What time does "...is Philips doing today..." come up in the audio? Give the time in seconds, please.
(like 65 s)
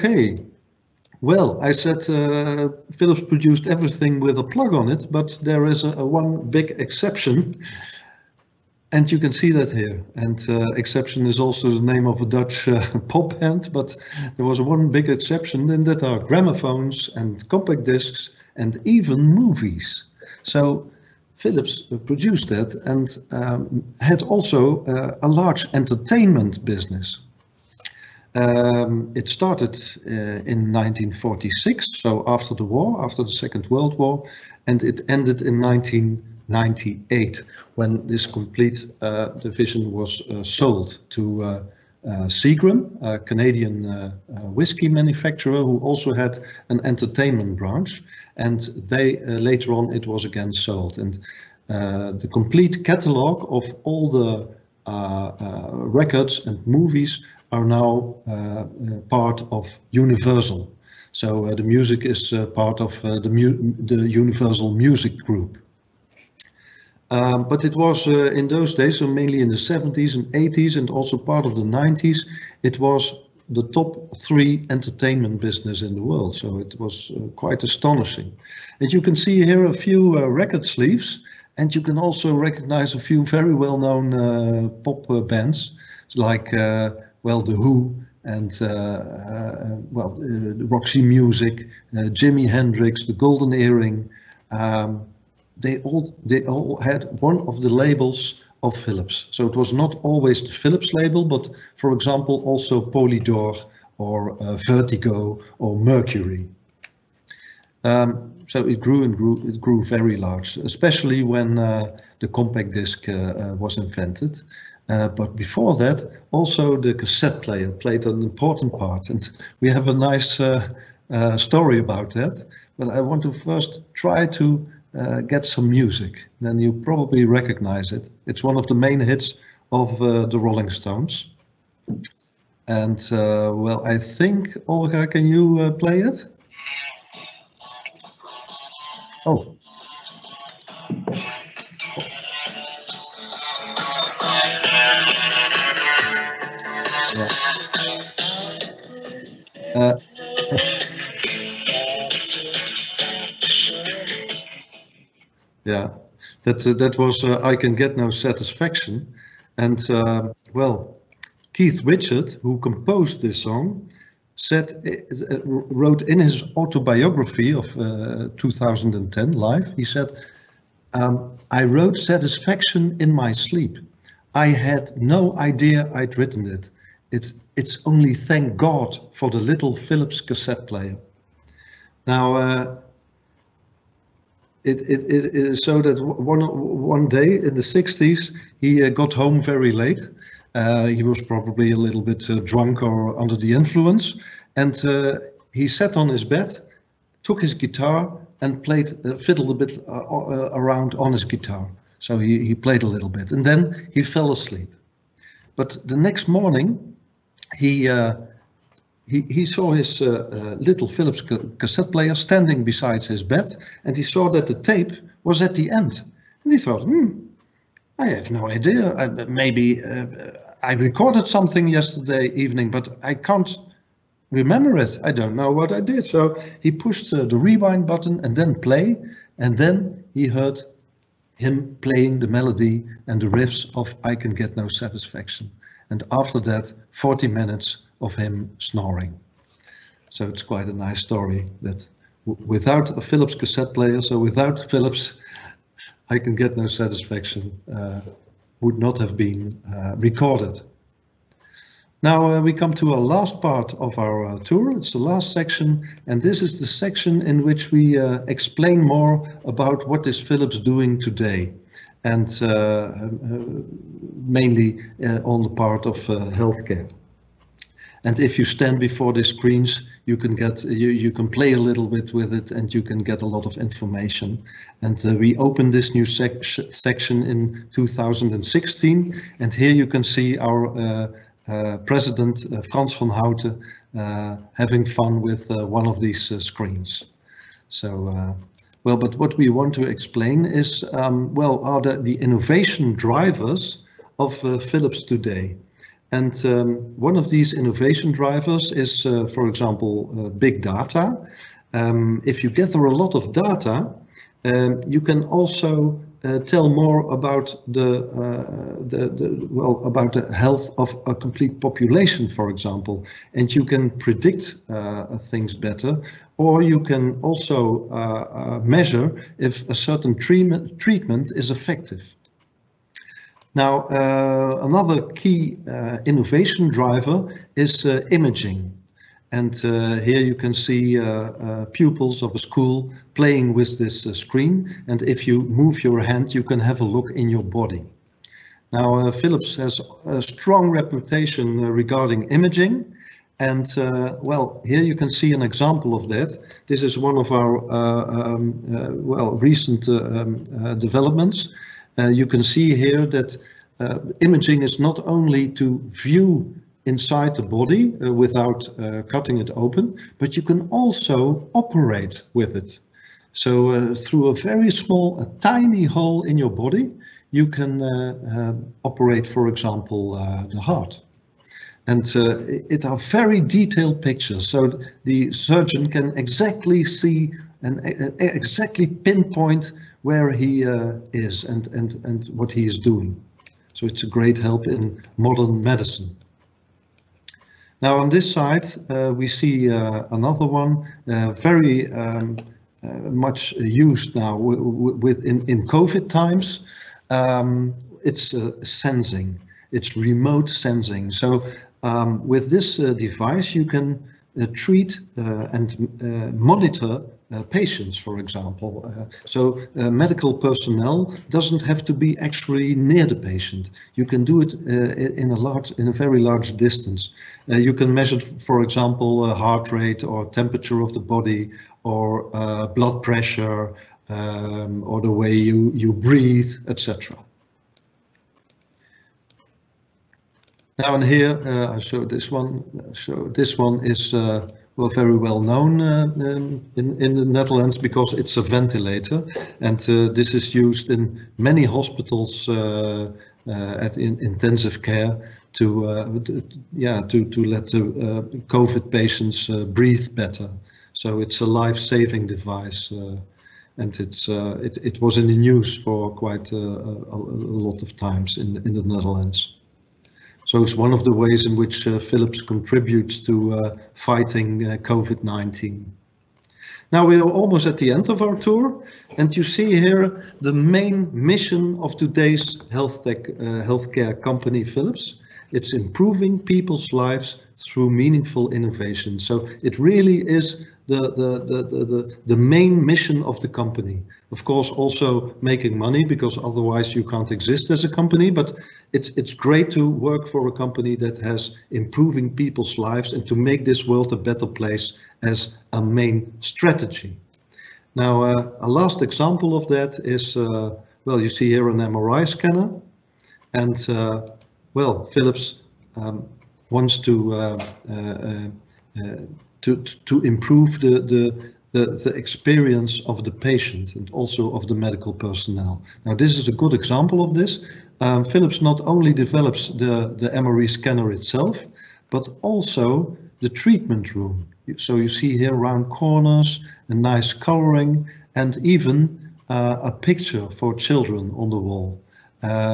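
260 s.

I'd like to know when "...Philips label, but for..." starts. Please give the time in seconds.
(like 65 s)
100 s.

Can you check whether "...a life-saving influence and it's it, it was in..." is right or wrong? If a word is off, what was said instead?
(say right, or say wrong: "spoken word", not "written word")
wrong: "device", not "influence".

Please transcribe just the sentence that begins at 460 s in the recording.
So it's one of the ways in which uh, Philips contributes to uh, fighting uh, COVID-19.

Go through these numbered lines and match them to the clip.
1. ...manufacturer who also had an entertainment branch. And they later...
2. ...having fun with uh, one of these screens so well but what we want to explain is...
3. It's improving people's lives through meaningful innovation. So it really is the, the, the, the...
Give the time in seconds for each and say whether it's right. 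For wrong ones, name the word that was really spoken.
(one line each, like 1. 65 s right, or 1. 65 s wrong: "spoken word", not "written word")
1. 44 s right
2. 284 s right
3. 475 s right.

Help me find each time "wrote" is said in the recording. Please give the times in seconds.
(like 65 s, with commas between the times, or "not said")
165 s, 171 s.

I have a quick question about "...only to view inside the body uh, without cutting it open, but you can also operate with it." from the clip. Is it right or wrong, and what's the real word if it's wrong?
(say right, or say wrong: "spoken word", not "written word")
right.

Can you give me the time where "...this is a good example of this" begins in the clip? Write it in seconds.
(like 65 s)
516 s.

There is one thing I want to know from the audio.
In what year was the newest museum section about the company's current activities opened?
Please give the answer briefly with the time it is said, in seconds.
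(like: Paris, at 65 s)
2016, at 277 s.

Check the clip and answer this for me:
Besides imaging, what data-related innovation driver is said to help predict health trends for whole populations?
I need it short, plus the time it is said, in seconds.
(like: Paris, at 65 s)
big data, at 300 s.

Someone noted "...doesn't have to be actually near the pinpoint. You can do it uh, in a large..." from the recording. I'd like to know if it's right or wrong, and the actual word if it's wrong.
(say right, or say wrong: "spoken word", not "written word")
wrong: "patient", not "pinpoint".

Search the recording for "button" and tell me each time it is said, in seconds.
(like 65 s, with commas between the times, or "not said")
227 s.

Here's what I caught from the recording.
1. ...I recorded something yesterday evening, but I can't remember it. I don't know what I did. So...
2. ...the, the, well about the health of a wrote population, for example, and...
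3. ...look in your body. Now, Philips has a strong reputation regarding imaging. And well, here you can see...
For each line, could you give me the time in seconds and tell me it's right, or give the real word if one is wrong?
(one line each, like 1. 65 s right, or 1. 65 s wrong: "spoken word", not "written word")
1. 220 s right
2. 308 s wrong: "complete", not "wrote"
3. 336 s right.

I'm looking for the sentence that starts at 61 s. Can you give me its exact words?
So the music is part of the, the Universal Music Group.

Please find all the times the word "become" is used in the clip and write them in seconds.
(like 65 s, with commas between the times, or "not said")
not said.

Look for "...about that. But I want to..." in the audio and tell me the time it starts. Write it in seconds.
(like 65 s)
121 s.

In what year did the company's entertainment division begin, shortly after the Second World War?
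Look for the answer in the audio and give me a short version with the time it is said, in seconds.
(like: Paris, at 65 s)
1946, at 30 s.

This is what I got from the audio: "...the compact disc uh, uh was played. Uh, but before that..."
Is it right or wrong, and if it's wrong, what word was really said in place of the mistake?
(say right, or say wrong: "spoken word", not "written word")
wrong: "invented", not "played".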